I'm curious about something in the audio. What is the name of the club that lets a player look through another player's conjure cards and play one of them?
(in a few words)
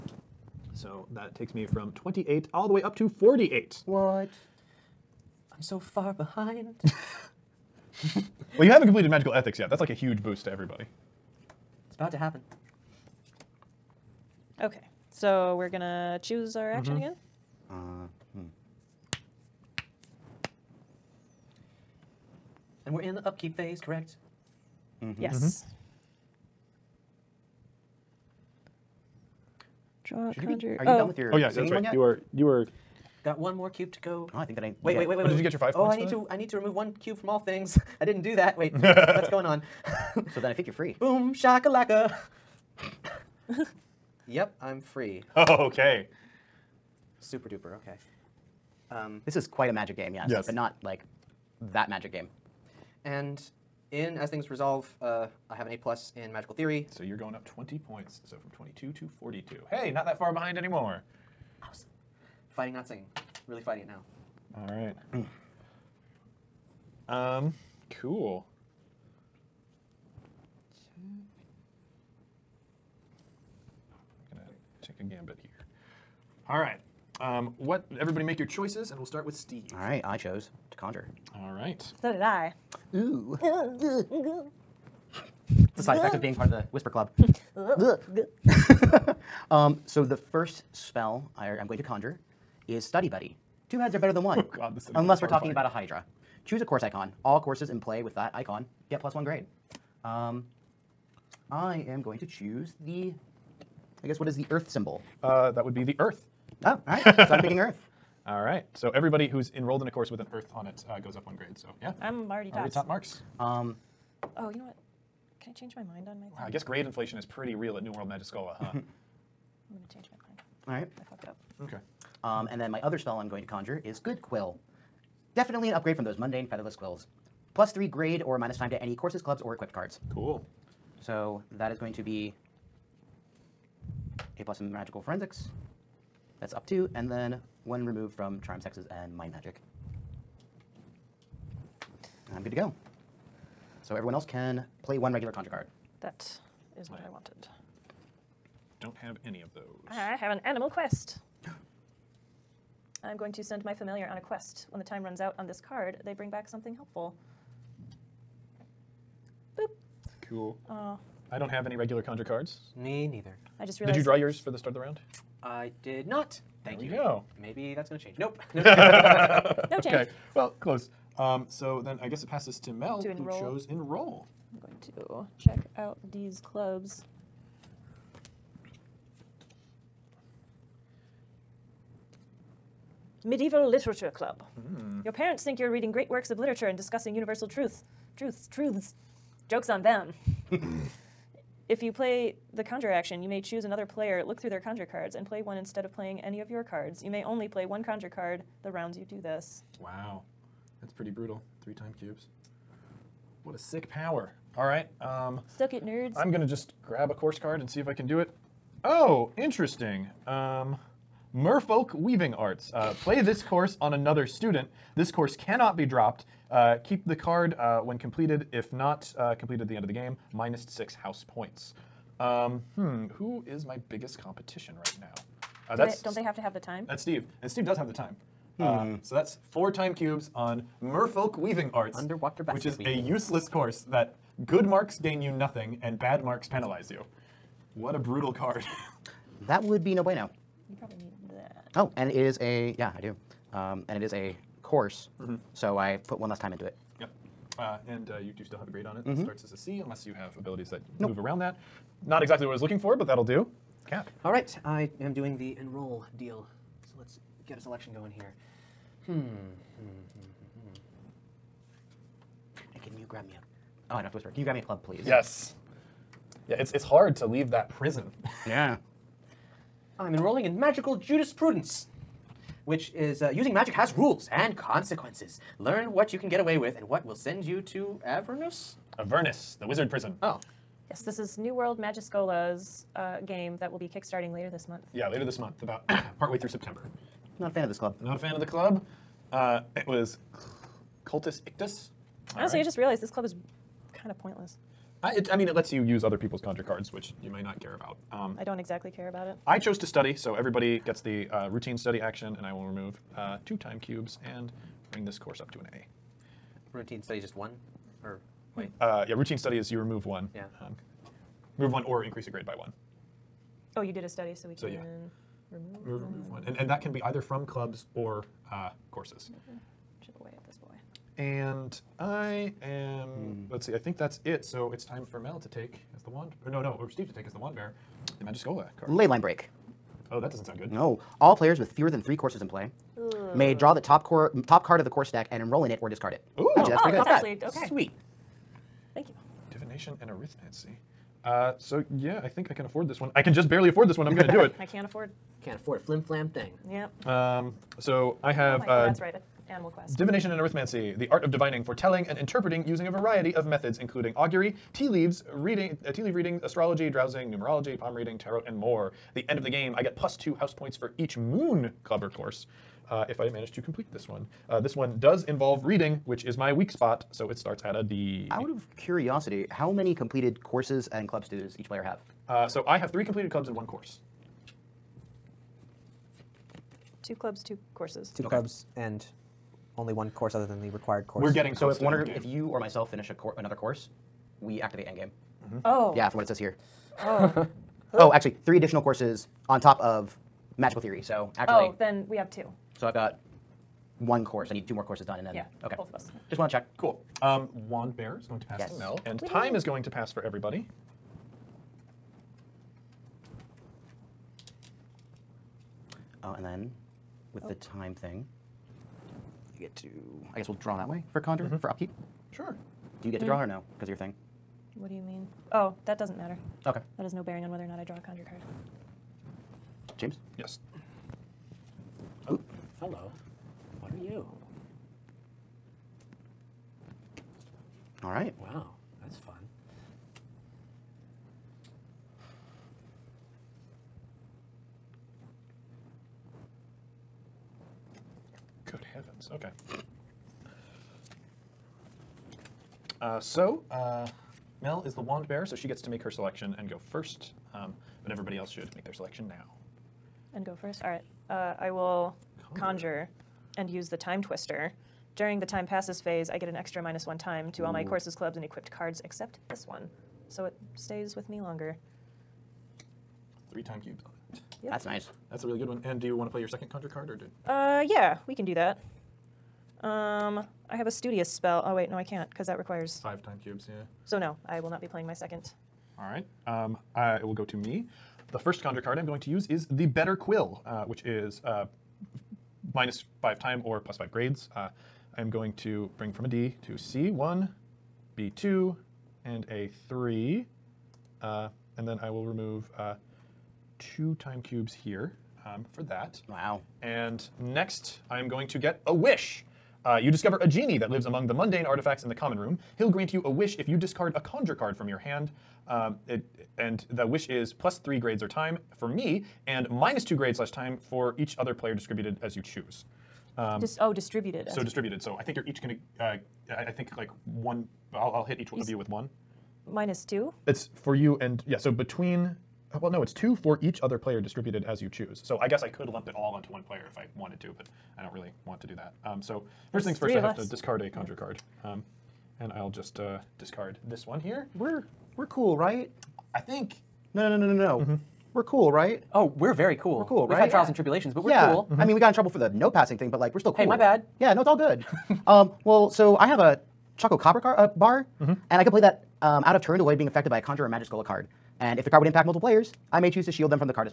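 Medieval Literature Club.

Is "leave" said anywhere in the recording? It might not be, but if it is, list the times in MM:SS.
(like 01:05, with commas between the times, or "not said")
04:27, 05:54.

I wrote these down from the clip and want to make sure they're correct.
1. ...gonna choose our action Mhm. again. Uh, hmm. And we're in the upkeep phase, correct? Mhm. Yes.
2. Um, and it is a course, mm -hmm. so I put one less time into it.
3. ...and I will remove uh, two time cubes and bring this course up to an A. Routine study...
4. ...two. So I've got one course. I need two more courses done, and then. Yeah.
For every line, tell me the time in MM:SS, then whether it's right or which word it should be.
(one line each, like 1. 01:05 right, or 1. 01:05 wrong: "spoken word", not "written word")
1. 00:15 right
2. 04:03 right
3. 05:02 right
4. 06:32 right.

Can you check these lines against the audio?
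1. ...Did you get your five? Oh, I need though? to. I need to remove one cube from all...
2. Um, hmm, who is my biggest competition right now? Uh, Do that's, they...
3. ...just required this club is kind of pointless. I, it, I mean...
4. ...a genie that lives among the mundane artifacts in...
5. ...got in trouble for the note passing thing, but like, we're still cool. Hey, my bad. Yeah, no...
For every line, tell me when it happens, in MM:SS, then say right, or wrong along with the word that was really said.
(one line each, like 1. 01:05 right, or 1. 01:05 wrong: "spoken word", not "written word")
1. 00:35 right
2. 03:42 right
3. 04:52 wrong: "realized", not "required"
4. 08:20 right
5. 09:01 right.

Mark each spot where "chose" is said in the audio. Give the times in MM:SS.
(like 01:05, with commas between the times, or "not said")
01:20, 02:53, 04:59.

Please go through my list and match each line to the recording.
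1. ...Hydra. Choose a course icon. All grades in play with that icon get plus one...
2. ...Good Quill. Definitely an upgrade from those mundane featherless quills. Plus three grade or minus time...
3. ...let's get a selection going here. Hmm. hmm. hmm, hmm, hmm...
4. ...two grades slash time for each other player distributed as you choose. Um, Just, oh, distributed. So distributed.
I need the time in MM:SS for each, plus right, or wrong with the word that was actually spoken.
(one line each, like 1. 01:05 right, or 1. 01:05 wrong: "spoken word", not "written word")
1. 01:35 wrong: "courses", not "grades"
2. 02:03 right
3. 04:16 right
4. 08:30 right.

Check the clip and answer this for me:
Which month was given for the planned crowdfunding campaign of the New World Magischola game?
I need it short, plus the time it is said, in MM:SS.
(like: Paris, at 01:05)
September, at 04:46.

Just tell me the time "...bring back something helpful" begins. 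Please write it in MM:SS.
02:36.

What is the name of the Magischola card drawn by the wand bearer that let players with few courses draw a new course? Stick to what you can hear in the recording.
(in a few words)
Leyline break.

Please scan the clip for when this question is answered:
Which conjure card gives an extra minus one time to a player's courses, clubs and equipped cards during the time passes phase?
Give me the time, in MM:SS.
07:33.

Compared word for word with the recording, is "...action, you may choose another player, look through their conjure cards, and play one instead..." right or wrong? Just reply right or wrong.
right.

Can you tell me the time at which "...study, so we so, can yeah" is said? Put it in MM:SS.
05:14.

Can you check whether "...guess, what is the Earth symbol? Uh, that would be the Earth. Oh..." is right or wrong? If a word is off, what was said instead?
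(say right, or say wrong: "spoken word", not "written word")
right.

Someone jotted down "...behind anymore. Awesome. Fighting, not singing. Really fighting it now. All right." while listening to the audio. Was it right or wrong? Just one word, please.
right.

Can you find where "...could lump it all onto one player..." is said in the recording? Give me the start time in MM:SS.
08:45.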